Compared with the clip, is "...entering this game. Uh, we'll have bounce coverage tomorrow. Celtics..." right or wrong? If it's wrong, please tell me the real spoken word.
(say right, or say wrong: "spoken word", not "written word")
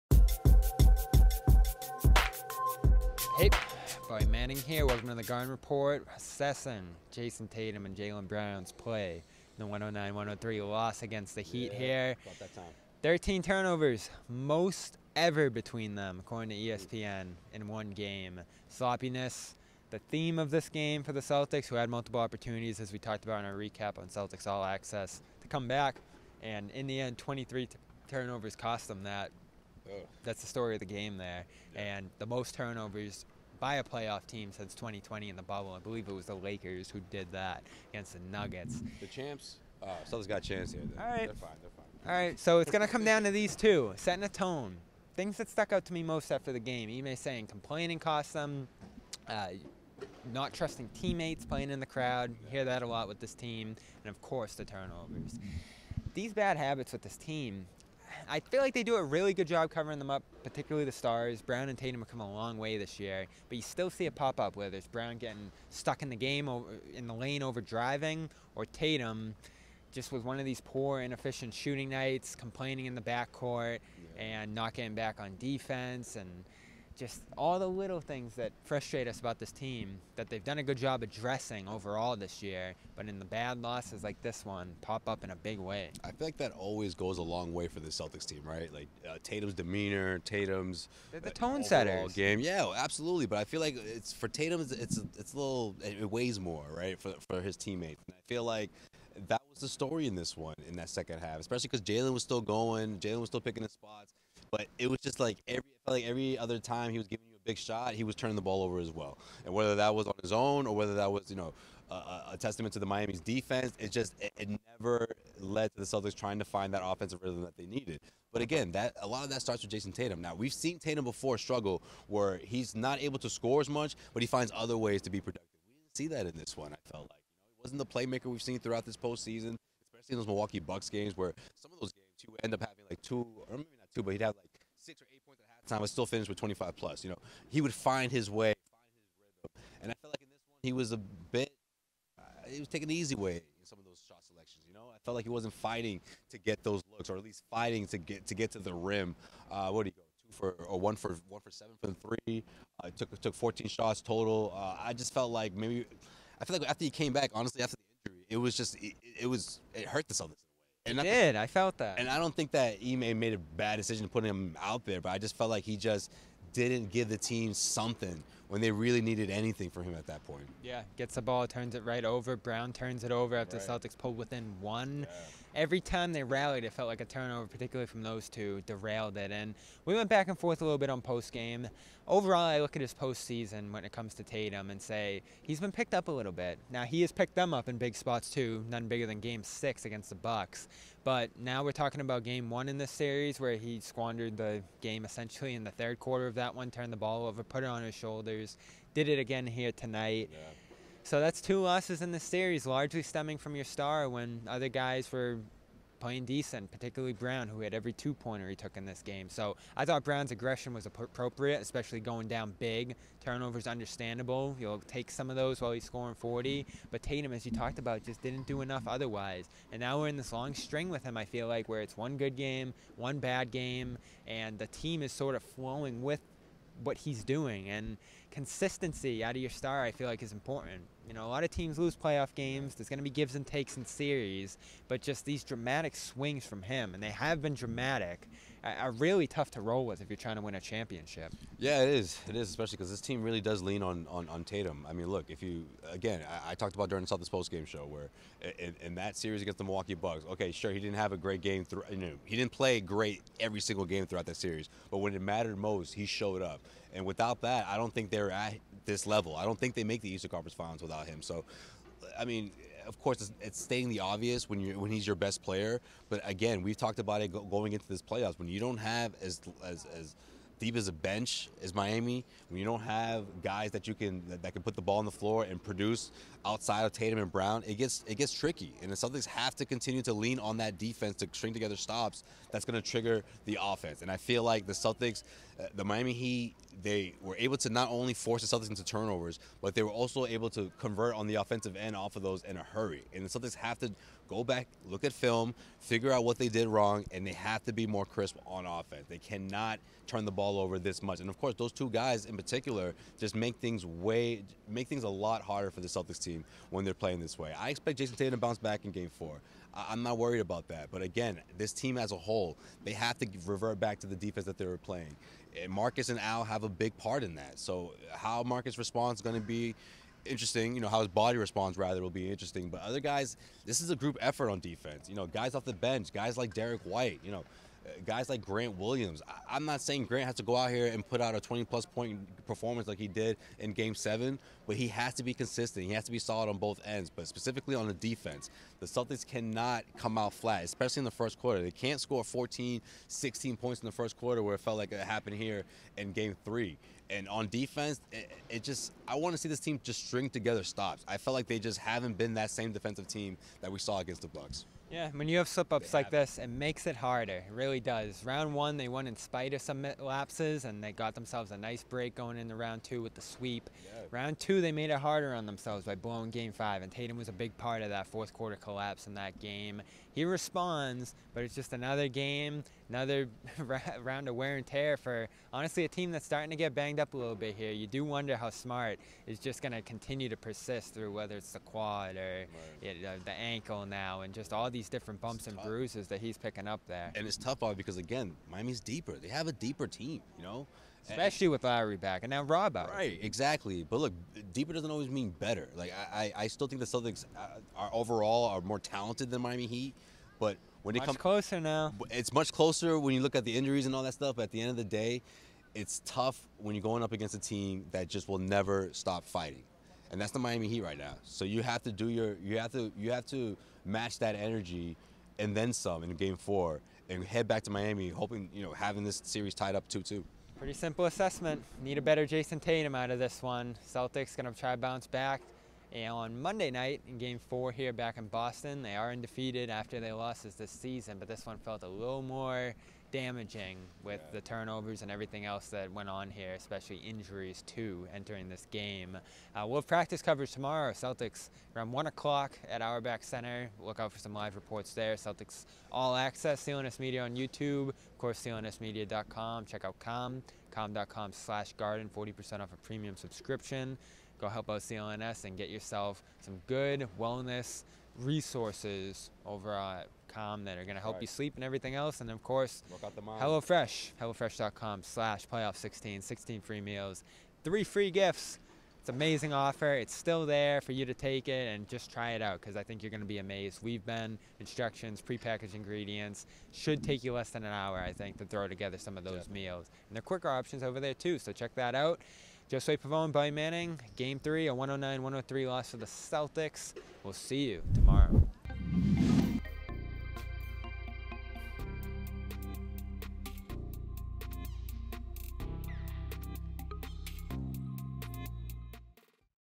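wrong: "practice", not "bounce".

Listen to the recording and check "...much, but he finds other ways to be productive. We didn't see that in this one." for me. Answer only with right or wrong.
right.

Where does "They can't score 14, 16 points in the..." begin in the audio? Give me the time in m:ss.
5:41.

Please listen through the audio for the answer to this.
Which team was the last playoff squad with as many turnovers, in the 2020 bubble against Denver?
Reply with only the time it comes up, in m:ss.
0:36.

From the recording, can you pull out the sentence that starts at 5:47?
And on defense, it, it just, I want to see this team just string together stops.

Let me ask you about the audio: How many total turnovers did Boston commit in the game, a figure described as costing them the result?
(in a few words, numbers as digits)
23.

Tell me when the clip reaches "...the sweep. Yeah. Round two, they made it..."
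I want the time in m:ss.
6:03.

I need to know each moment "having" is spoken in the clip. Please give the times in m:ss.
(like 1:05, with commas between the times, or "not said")
2:12, 6:58.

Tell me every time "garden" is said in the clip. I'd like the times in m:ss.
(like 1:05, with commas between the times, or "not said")
0:05, 7:31.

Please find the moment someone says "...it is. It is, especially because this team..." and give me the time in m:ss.
4:01.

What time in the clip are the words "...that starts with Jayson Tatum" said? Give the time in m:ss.
1:59.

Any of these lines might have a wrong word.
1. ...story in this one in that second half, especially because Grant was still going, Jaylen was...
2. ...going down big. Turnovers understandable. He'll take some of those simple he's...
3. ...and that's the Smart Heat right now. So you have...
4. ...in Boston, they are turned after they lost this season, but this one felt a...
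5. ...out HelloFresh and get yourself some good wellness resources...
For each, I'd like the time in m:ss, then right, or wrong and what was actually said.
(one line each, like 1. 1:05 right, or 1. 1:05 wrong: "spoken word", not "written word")
1. 1:39 wrong: "Jaylen", not "Grant"
2. 3:31 wrong: "while", not "simple"
3. 6:50 wrong: "Miami", not "Smart"
4. 7:08 wrong: "undefeated", not "turned"
5. 7:34 wrong: "CLNS", not "HelloFresh".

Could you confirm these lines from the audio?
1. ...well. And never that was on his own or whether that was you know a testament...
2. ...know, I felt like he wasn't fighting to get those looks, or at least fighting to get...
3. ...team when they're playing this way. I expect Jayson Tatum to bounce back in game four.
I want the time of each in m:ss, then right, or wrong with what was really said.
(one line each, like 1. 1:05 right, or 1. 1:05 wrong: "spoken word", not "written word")
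1. 1:48 wrong: "whether", not "never"
2. 2:24 right
3. 5:06 right.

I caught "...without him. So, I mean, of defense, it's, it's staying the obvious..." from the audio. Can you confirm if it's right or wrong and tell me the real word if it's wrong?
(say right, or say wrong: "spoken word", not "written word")
wrong: "course", not "defense".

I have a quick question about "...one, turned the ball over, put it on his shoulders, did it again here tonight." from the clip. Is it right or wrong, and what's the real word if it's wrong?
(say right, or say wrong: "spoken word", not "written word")
right.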